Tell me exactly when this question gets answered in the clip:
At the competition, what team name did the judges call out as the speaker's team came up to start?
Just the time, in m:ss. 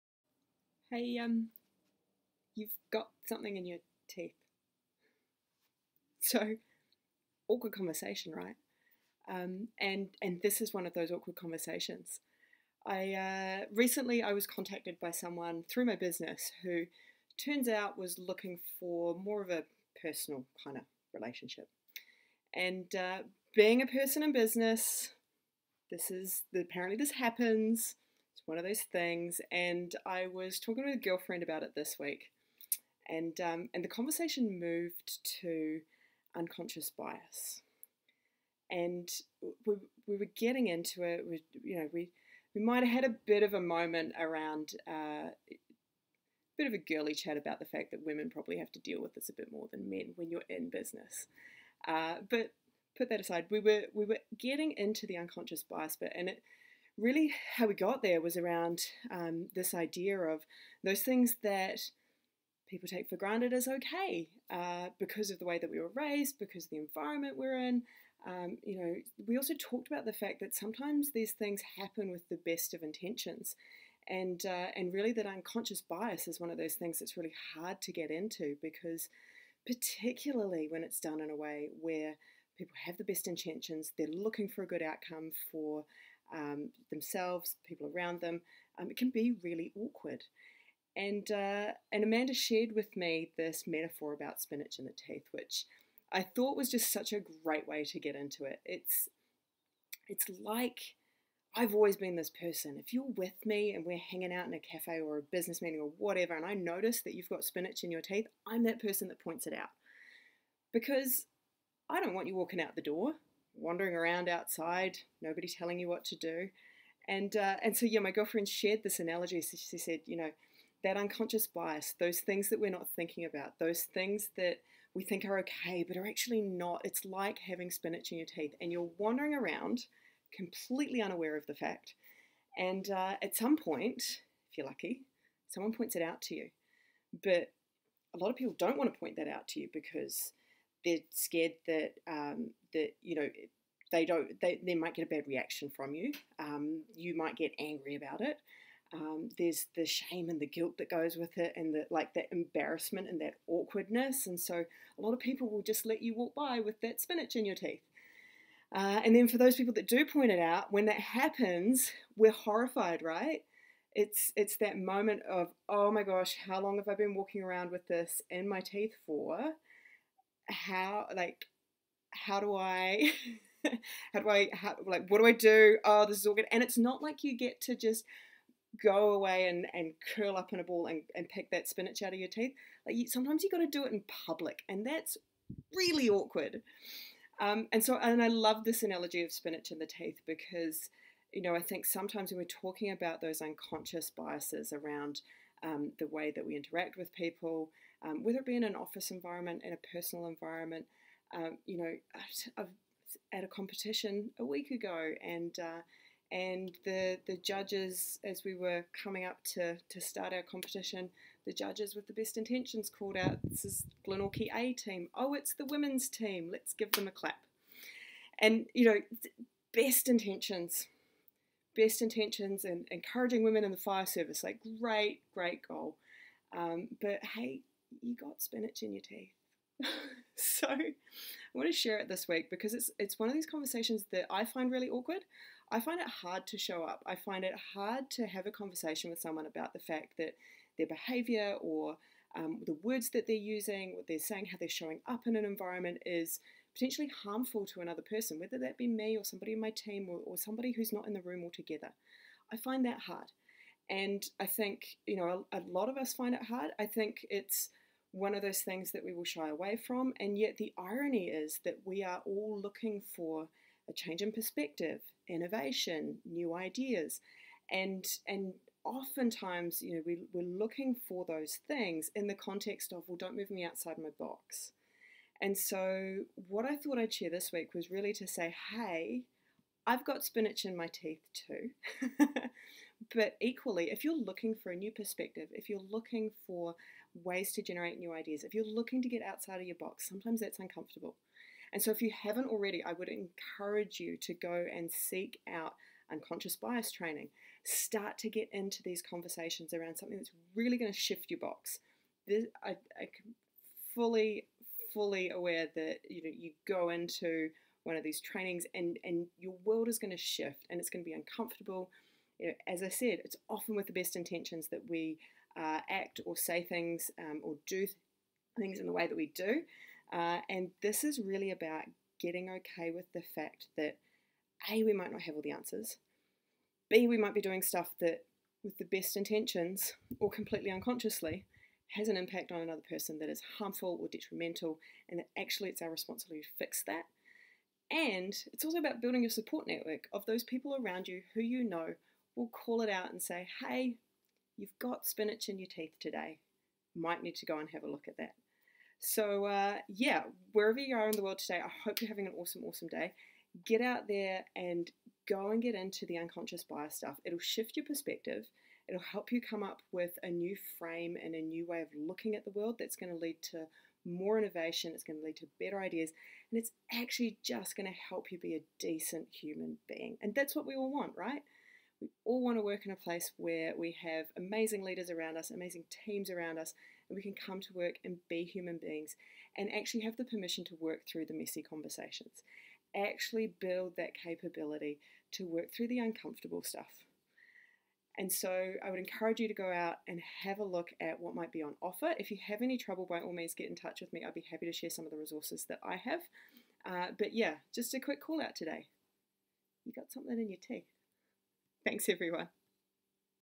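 3:34.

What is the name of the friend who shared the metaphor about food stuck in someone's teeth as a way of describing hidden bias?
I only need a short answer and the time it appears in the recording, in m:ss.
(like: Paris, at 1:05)
Amanda, at 1:32.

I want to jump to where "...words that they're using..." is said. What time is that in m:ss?
4:02.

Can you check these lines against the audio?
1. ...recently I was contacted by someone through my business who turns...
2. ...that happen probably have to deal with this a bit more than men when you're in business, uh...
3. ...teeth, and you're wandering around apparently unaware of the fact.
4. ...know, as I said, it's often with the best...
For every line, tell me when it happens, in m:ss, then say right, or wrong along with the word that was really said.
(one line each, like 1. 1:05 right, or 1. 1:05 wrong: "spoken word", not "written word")
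1. 0:13 right
2. 0:47 wrong: "women", not "happen"
3. 2:08 wrong: "completely", not "apparently"
4. 5:12 right.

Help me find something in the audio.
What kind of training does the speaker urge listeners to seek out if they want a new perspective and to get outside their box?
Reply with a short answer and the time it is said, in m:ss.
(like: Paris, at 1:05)
Unconscious bias training, at 4:56.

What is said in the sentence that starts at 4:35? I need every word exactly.
And so, what I thought I'd share this week was really to say, hey, I've got spinach in my teeth too.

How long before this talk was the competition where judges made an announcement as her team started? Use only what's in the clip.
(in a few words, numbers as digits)
A week ago.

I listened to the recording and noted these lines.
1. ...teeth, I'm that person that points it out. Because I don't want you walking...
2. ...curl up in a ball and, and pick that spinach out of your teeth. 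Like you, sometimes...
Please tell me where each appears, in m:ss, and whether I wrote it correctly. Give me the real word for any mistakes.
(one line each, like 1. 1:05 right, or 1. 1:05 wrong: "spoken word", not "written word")
1. 1:48 right
2. 3:00 right.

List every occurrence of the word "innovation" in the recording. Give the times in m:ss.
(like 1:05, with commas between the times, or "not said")
4:25, 6:04.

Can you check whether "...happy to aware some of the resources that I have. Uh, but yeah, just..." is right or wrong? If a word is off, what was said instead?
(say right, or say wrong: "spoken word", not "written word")
wrong: "share", not "aware".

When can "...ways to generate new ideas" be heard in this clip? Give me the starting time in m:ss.
4:47.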